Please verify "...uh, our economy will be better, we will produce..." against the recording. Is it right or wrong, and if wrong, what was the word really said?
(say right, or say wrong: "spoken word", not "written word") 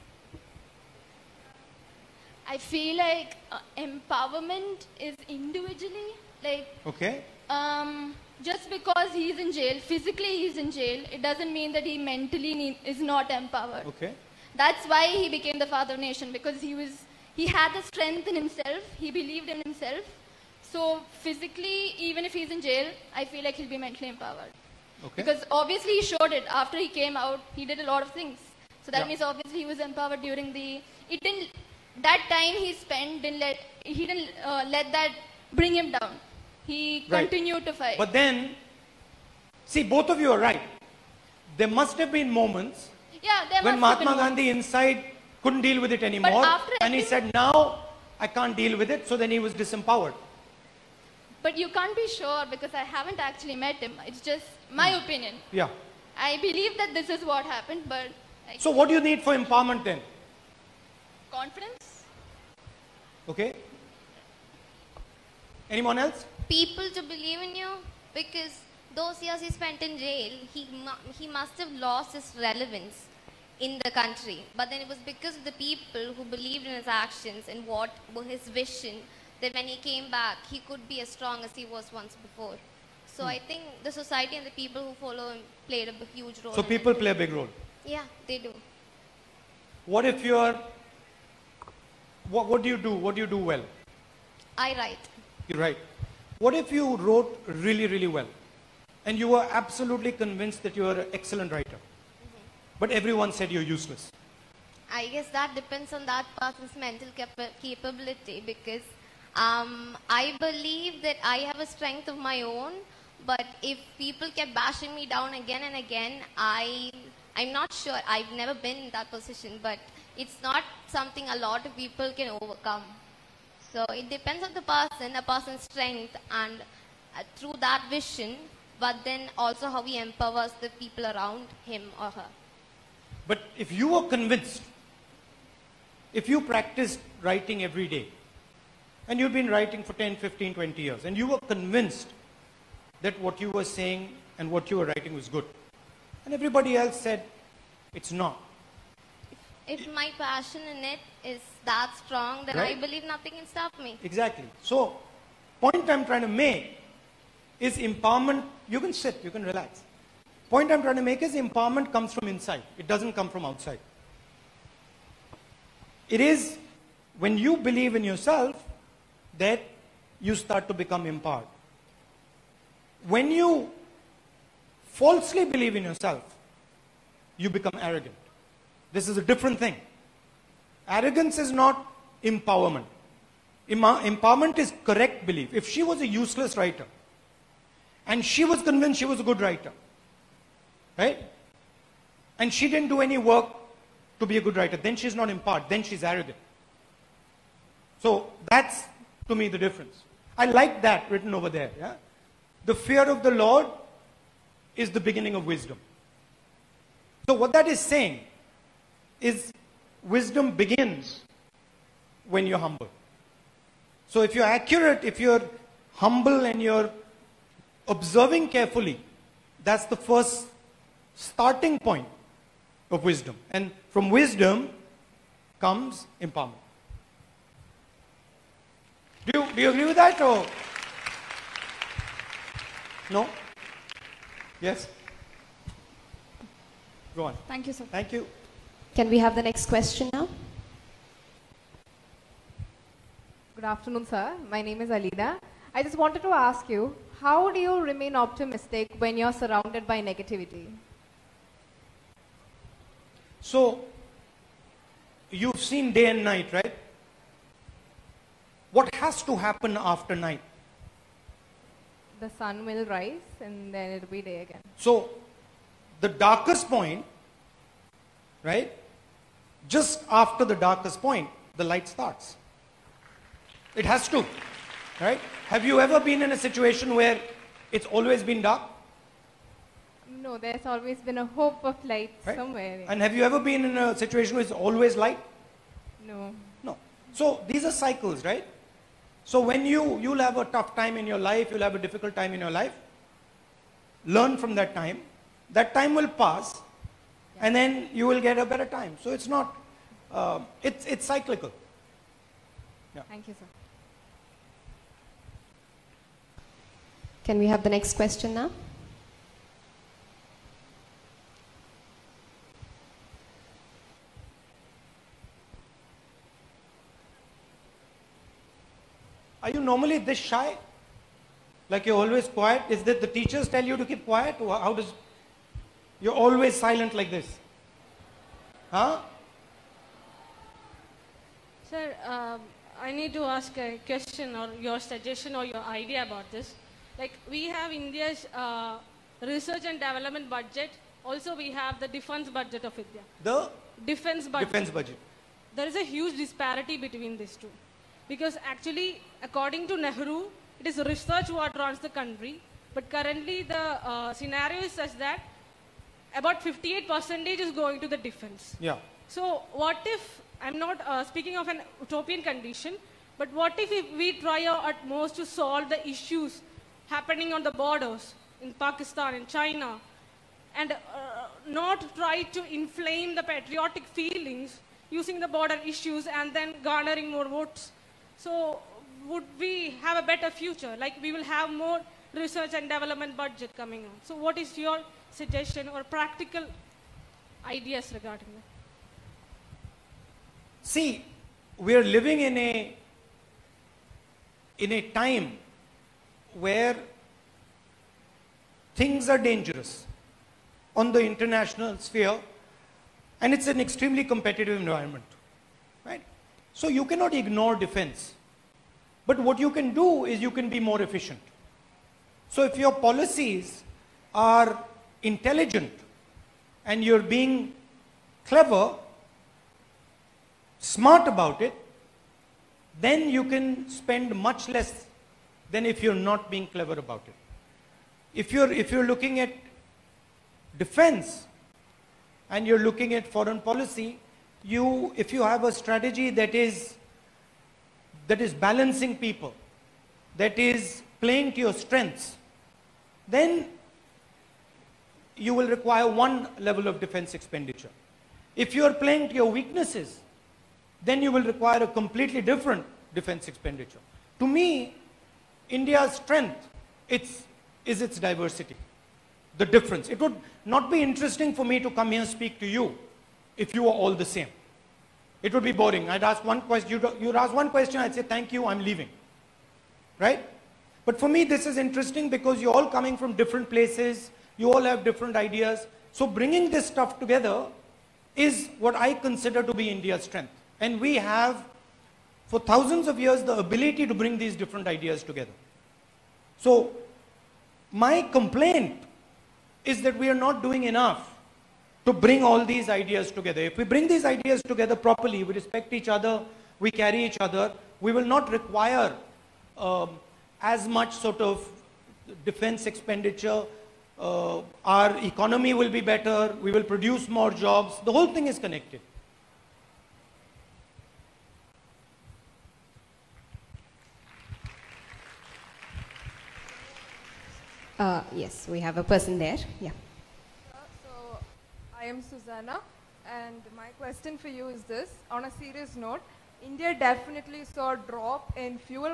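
right.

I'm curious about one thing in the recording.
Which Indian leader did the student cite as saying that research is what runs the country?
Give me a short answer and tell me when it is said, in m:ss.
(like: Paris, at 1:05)
Nehru, at 5:49.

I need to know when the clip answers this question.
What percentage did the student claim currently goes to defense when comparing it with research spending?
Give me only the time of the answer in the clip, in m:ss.
5:56.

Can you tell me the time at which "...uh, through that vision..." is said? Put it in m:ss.
2:07.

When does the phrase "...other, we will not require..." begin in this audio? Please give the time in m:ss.
8:17.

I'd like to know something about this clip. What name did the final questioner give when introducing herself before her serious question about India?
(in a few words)
Susanna.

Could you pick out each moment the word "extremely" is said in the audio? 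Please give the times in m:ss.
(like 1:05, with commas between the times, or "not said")
6:43.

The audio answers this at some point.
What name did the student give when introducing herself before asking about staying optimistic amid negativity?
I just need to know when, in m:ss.
4:04.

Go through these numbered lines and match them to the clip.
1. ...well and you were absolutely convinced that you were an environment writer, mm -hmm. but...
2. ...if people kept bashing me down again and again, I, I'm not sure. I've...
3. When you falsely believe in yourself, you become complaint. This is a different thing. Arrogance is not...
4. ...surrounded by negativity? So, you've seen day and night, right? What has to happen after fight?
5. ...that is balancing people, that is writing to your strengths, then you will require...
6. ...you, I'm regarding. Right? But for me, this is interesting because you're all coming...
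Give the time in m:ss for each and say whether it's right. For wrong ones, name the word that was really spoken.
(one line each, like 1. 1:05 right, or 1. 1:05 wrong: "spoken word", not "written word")
1. 1:38 wrong: "excellent", not "environment"
2. 1:53 right
3. 2:53 wrong: "arrogant", not "complaint"
4. 4:09 wrong: "night", not "fight"
5. 7:18 wrong: "playing", not "writing"
6. 7:48 wrong: "leaving", not "regarding".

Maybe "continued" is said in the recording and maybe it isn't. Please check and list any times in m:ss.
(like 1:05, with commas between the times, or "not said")
0:37.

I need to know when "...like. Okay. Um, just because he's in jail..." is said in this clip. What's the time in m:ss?
0:06.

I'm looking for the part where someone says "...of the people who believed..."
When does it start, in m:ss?
1:15.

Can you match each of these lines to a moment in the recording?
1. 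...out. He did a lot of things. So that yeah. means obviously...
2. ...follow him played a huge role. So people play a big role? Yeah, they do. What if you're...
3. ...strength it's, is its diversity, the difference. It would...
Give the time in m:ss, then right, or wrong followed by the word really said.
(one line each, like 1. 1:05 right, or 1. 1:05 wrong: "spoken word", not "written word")
1. 0:27 right
2. 1:24 right
3. 7:35 right.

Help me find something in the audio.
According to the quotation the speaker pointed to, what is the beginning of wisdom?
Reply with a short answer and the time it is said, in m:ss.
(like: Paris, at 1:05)
The fear of the Lord, at 3:22.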